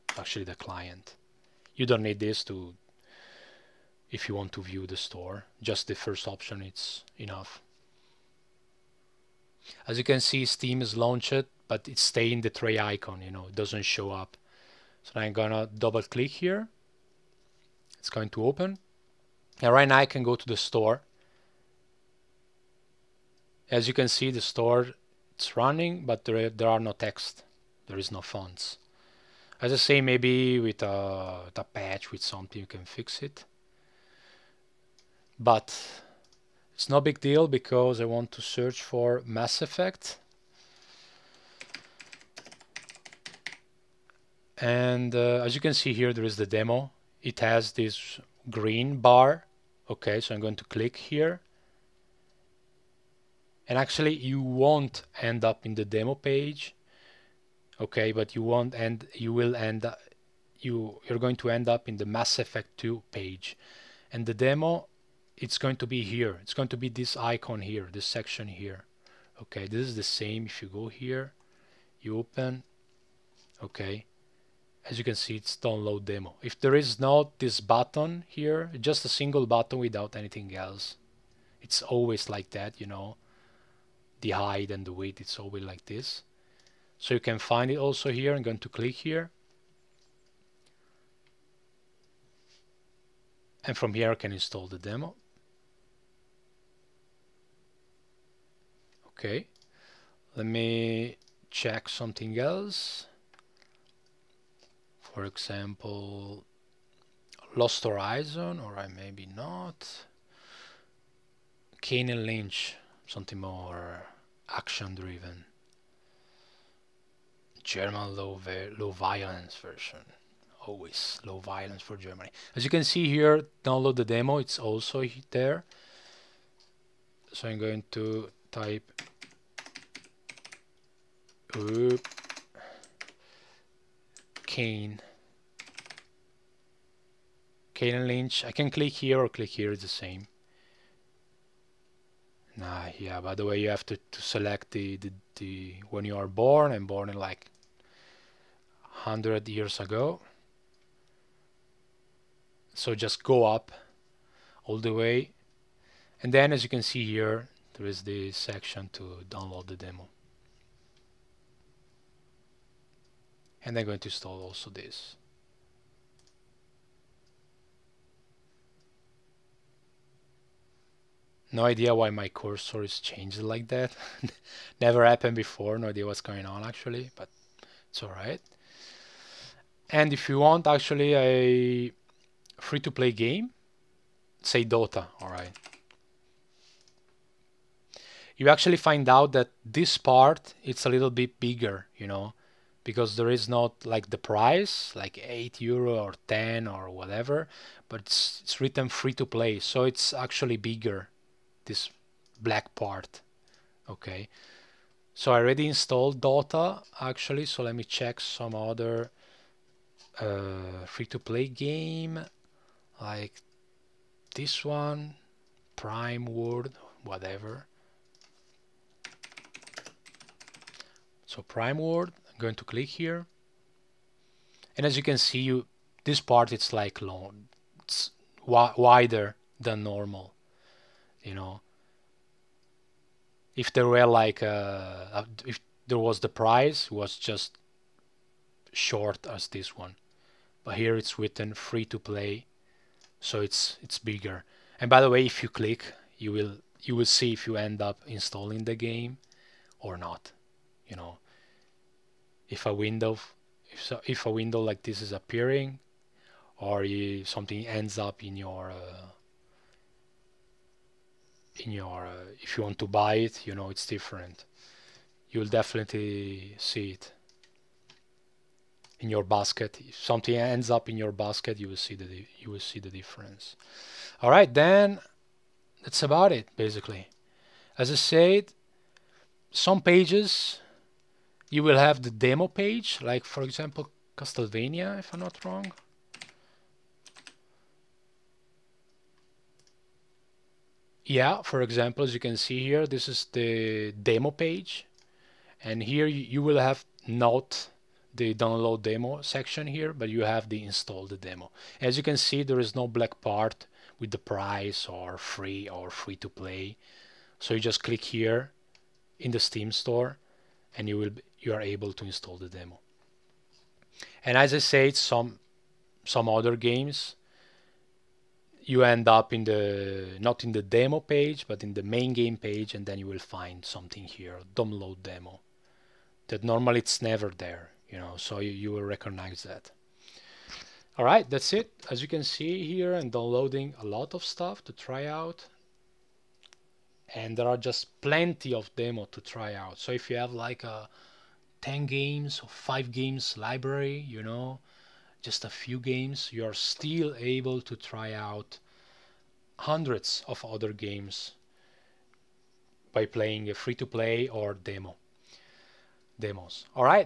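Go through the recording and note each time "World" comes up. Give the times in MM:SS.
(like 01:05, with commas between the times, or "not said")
03:36, 03:41.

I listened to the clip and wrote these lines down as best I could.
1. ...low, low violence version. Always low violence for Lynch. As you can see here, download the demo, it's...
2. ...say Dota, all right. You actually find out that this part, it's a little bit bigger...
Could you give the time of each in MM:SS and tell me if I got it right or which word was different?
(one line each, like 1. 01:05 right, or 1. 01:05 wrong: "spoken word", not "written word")
1. 01:58 wrong: "Germany", not "Lynch"
2. 03:04 right.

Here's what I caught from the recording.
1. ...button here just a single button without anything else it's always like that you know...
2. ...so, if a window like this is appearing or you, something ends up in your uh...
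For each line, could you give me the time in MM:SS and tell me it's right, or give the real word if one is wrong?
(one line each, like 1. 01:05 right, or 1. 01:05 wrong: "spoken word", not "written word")
1. 01:17 right
2. 04:13 right.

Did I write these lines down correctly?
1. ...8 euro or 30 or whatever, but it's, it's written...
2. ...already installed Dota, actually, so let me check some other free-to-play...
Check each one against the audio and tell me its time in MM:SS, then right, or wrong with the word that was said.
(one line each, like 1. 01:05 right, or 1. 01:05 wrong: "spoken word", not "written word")
1. 03:15 wrong: "10", not "30"
2. 03:25 right.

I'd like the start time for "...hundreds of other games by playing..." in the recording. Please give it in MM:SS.
05:49.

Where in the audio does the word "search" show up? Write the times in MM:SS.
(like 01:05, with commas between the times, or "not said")
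00:38.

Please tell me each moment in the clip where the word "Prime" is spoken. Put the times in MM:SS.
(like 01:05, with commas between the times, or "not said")
03:35, 03:41.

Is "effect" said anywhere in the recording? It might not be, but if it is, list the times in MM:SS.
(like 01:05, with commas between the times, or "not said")
00:39, 01:02.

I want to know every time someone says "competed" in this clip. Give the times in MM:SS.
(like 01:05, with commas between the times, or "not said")
not said.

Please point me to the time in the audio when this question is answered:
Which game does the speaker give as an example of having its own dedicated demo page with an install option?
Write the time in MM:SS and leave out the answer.
04:44.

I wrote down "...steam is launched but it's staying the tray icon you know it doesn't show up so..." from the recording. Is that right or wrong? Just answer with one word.
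right.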